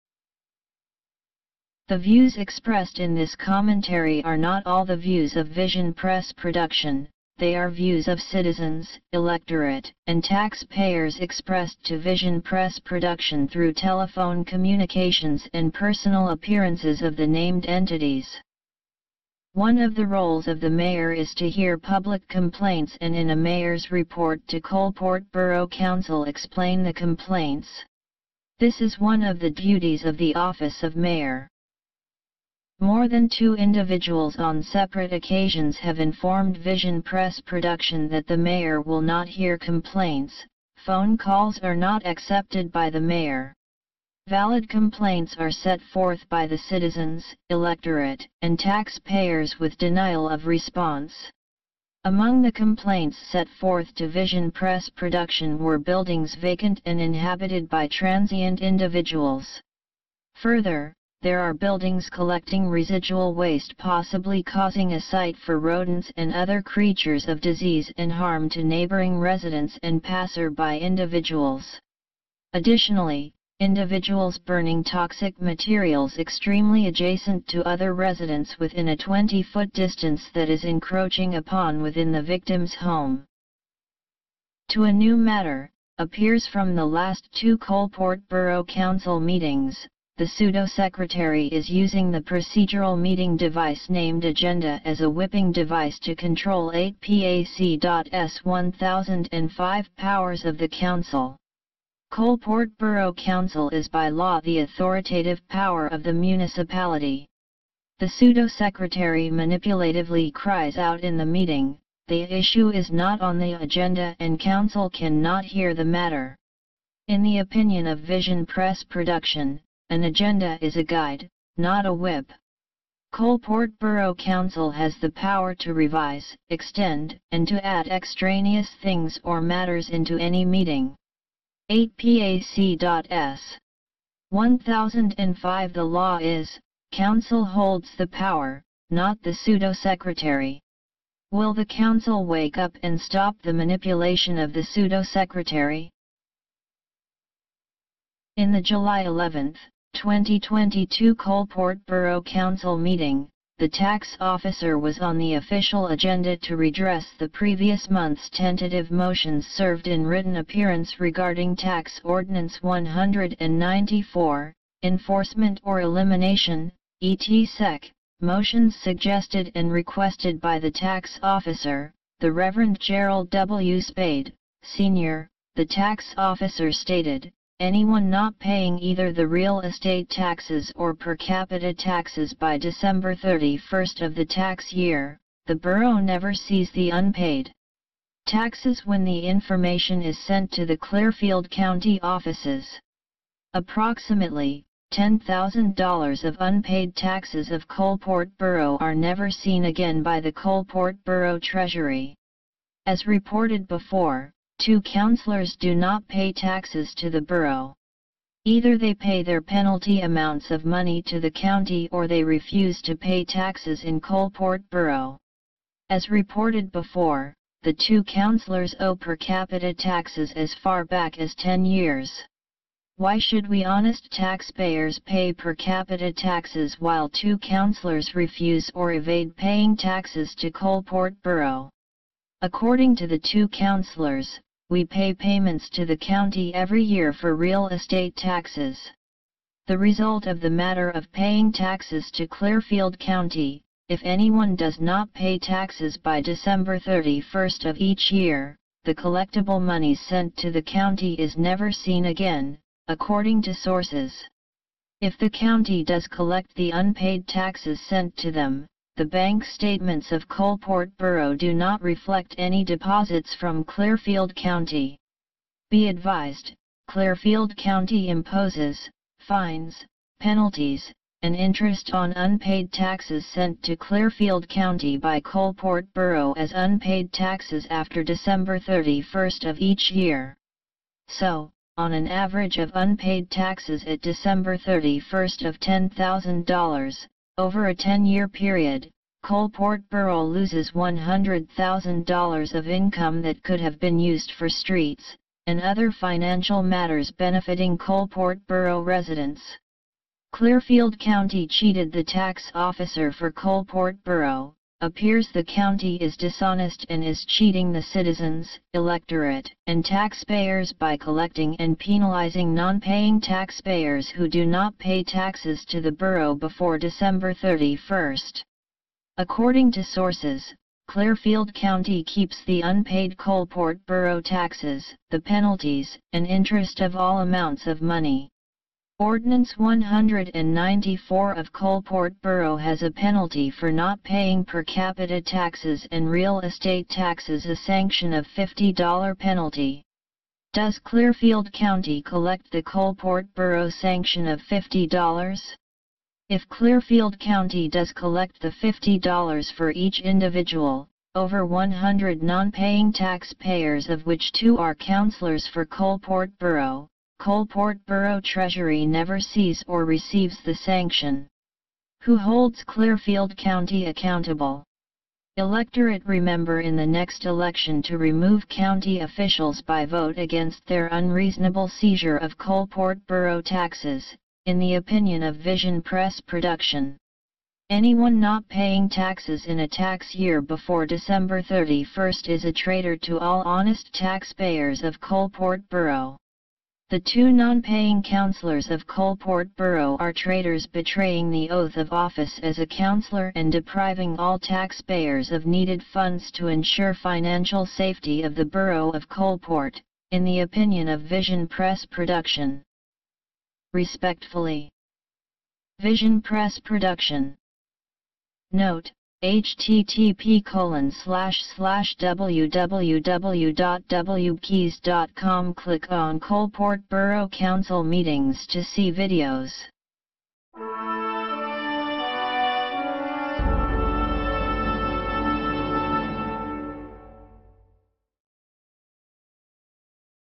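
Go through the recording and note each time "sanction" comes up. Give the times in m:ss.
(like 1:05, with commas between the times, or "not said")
5:37, 5:43, 6:00.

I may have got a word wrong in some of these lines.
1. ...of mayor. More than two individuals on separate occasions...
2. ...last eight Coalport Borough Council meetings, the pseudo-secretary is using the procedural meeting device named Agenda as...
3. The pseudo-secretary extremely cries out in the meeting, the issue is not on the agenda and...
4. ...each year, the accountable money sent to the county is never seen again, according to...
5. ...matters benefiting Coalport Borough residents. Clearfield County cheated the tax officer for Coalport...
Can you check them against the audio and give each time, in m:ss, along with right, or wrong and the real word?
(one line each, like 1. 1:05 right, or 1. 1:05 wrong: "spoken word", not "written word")
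1. 0:30 right
2. 1:26 wrong: "two", not "eight"
3. 1:47 wrong: "manipulatively", not "extremely"
4. 4:07 wrong: "collectible", not "accountable"
5. 4:56 right.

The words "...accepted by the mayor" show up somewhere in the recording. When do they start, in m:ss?
0:42.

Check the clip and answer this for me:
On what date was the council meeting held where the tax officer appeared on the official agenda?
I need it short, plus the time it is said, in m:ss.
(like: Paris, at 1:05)
July 11, 2022, at 2:28.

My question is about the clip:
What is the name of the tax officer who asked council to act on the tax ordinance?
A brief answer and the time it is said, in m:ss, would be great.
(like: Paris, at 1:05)
Gerald W. Spade, Sr., at 2:52.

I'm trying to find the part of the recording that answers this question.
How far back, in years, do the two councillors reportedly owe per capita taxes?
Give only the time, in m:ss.
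3:41.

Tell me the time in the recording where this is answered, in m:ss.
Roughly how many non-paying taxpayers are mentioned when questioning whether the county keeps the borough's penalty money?
5:51.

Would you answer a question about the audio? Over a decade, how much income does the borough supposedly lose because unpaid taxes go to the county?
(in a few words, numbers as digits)
$100,000.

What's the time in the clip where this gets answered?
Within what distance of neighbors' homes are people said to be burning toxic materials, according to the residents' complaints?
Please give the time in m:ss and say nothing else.
1:18.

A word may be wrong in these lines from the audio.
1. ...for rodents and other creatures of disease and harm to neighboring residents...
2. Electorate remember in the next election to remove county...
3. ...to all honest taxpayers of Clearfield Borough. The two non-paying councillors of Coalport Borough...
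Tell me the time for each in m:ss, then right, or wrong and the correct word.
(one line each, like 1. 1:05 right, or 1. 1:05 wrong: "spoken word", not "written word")
1. 1:05 right
2. 6:05 right
3. 6:22 wrong: "Coalport", not "Clearfield".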